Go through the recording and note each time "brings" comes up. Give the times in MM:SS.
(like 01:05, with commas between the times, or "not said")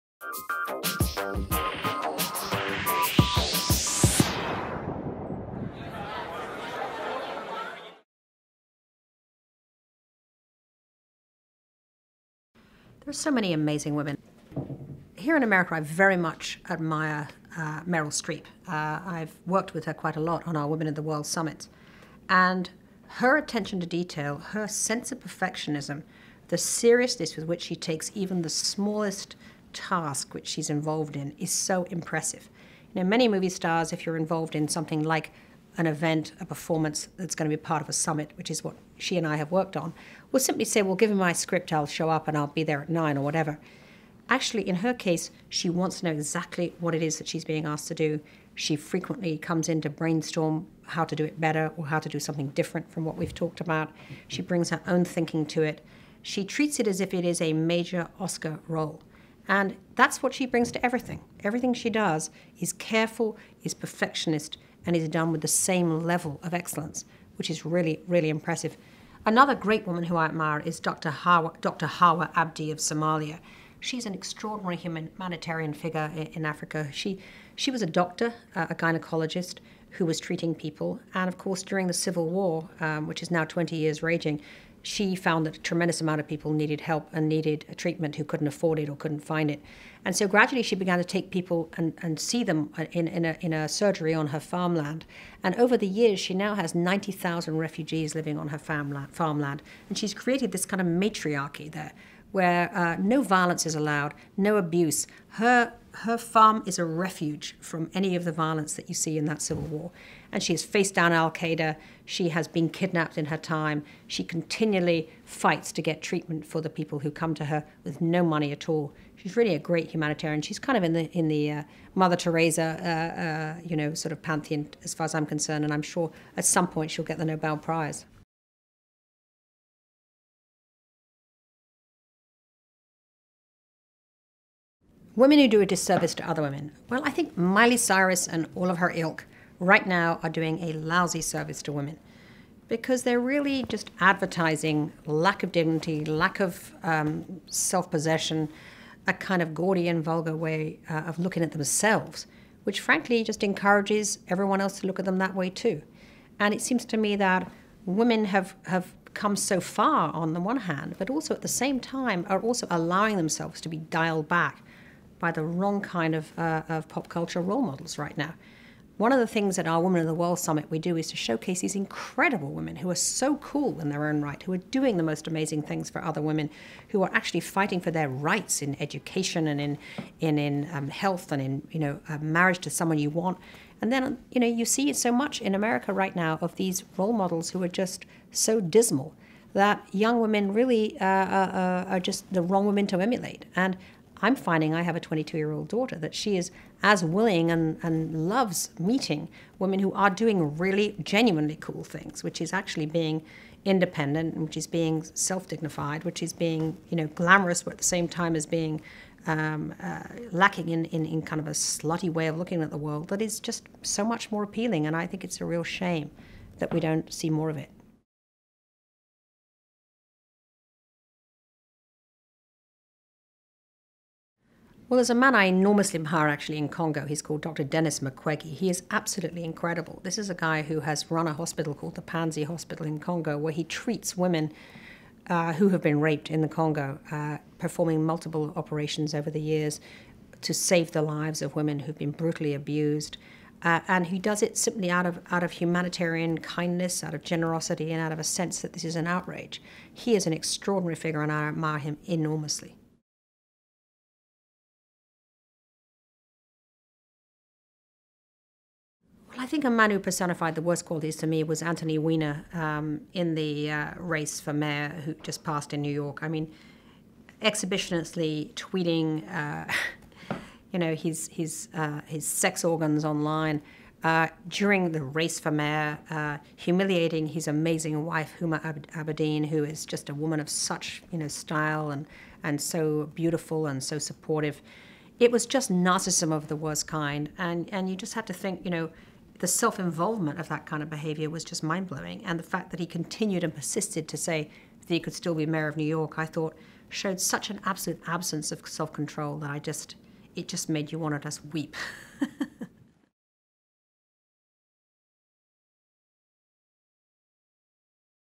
00:54, 01:00.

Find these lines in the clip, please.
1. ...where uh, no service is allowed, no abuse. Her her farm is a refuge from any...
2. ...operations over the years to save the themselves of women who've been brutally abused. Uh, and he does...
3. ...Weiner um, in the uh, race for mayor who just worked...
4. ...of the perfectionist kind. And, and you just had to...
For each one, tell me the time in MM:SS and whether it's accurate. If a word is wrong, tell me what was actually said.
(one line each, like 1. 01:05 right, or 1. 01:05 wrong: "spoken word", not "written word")
1. 01:42 wrong: "violence", not "service"
2. 03:58 wrong: "lives", not "themselves"
3. 04:21 wrong: "passed", not "worked"
4. 04:46 wrong: "worst", not "perfectionist".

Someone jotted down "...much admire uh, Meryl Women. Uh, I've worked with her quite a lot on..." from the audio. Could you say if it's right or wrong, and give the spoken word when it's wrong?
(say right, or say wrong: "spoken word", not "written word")
wrong: "Streep", not "Women".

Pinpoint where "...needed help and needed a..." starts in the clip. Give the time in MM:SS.
01:26.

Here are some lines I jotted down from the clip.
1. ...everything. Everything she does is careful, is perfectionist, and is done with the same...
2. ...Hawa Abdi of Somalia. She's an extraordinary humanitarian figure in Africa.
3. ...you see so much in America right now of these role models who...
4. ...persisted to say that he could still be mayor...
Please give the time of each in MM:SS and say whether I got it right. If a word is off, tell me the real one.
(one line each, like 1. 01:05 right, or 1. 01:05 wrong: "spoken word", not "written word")
1. 01:00 right
2. 01:11 right
3. 03:04 right
4. 04:53 right.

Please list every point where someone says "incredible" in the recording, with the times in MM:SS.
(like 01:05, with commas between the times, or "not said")
02:51, 03:49.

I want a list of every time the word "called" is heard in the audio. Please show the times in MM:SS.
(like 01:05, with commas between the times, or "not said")
03:47, 03:51.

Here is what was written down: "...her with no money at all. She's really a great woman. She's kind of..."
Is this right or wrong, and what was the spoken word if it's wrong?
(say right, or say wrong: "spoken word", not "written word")
wrong: "humanitarian", not "woman".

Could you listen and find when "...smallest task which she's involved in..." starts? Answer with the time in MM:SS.
00:28.